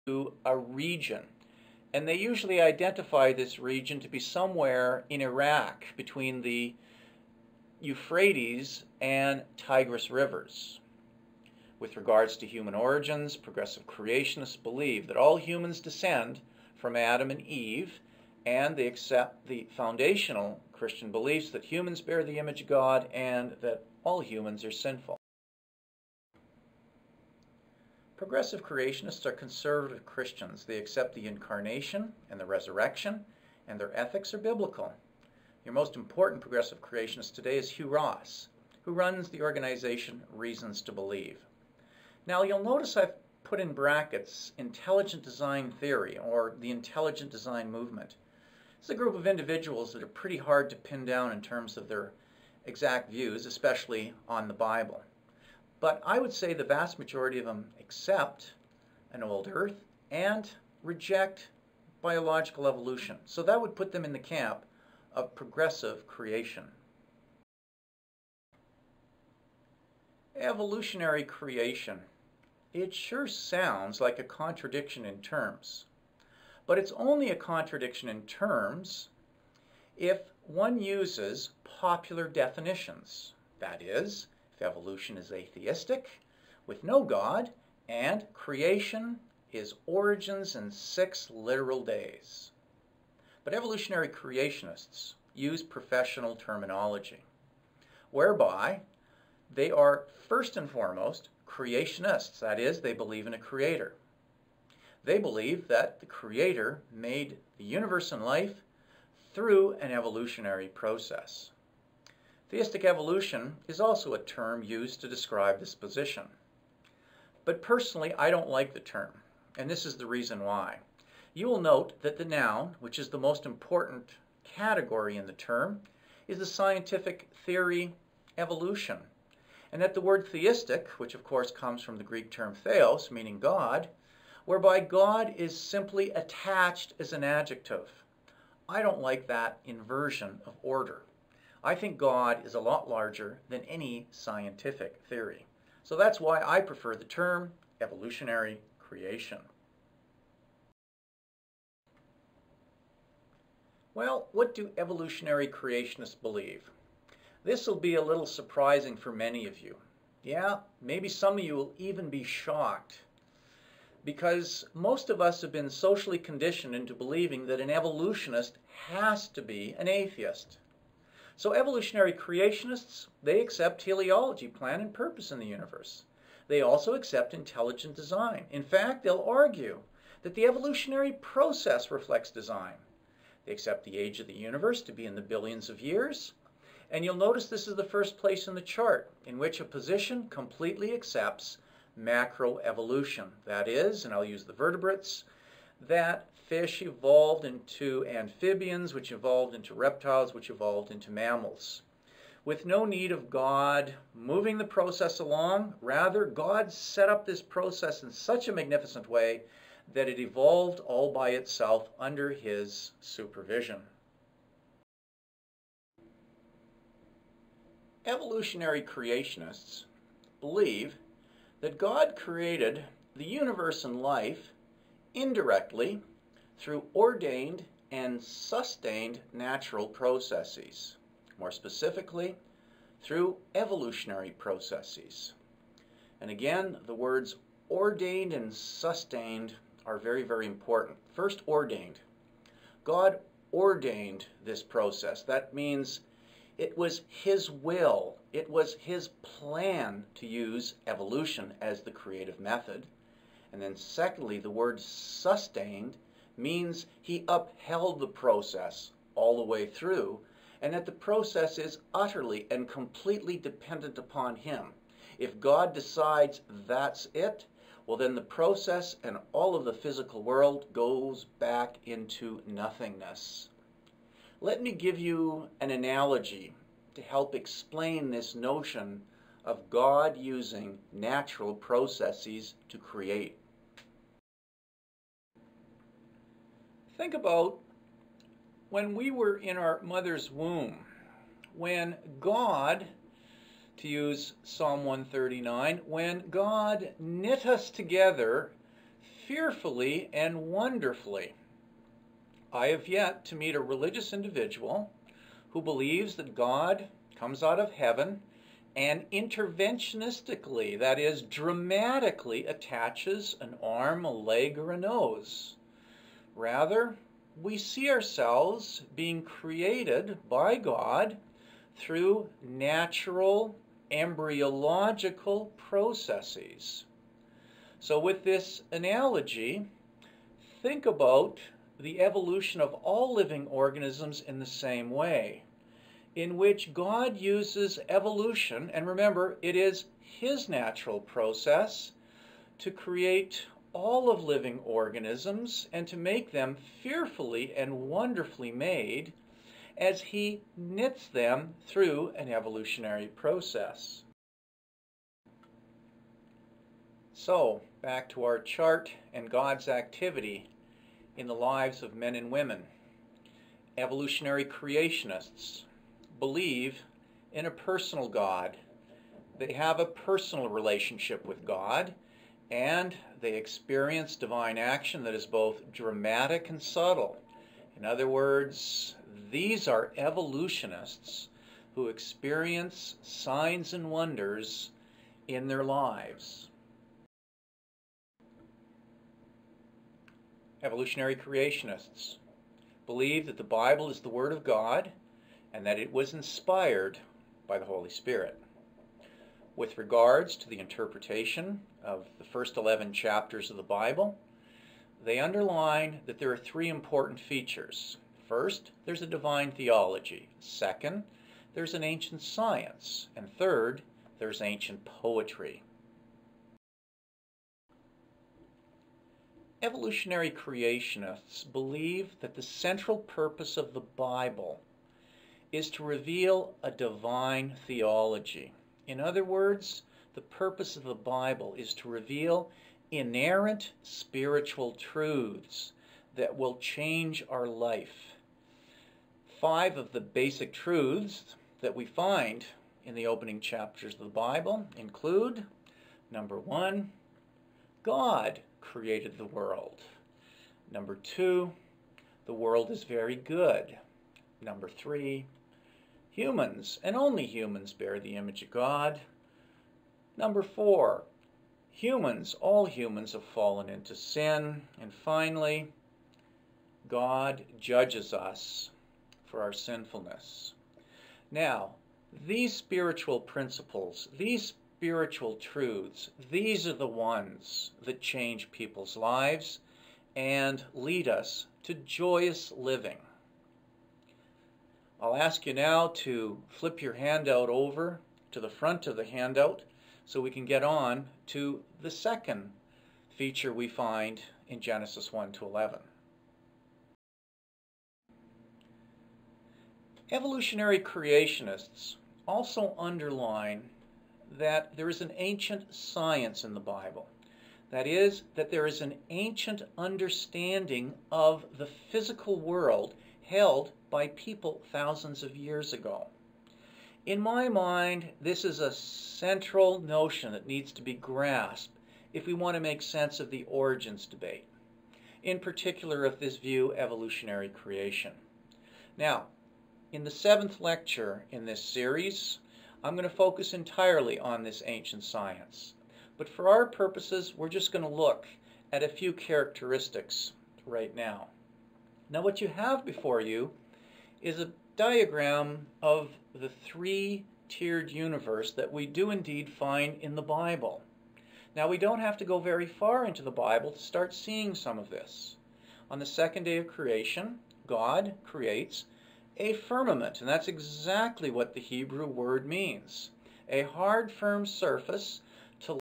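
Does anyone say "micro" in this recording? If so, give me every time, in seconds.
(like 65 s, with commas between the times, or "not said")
not said.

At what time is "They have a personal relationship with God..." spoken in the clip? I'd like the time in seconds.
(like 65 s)
369 s.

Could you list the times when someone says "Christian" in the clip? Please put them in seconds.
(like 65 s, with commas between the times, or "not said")
20 s, 30 s.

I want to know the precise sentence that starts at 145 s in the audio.
So that's why I prefer the term evolutionary creation.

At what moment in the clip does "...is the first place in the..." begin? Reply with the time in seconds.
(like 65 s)
187 s.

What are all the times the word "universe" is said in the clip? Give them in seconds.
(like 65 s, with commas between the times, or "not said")
107 s, 175 s, 184 s, 223 s, 547 s.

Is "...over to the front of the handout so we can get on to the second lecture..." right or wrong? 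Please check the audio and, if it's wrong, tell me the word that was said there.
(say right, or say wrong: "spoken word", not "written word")
wrong: "feature", not "lecture".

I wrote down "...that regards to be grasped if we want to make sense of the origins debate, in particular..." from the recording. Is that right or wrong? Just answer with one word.
wrong.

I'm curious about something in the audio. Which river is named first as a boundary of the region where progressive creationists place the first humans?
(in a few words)
Euphrates.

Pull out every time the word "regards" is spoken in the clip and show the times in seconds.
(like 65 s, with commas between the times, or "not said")
11 s, 399 s.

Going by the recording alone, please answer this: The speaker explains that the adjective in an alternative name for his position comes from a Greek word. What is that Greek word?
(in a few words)
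theos.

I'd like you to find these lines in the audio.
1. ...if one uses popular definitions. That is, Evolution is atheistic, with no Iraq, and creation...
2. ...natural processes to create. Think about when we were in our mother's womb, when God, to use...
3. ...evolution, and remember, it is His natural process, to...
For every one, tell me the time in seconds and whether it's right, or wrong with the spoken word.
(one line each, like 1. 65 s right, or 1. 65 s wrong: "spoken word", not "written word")
1. 79 s wrong: "God", not "Iraq"
2. 280 s right
3. 337 s right.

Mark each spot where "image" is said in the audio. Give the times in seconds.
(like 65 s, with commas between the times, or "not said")
22 s, 458 s.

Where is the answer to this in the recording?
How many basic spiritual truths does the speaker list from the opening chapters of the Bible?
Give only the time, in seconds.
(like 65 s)
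439 s.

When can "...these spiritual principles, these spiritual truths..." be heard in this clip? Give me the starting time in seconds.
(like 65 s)
472 s.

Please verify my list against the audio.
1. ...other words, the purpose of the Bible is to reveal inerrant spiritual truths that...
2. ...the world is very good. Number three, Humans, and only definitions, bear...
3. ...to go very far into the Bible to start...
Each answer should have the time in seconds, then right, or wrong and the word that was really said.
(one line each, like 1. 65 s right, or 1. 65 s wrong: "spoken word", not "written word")
1. 429 s right
2. 452 s wrong: "humans", not "definitions"
3. 552 s right.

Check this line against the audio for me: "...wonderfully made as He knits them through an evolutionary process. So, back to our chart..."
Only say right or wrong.
right.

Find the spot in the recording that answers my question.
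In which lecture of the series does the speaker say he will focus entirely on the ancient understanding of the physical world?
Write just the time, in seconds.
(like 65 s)
530 s.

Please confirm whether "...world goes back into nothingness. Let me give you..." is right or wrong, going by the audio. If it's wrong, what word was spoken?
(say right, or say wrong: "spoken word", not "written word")
right.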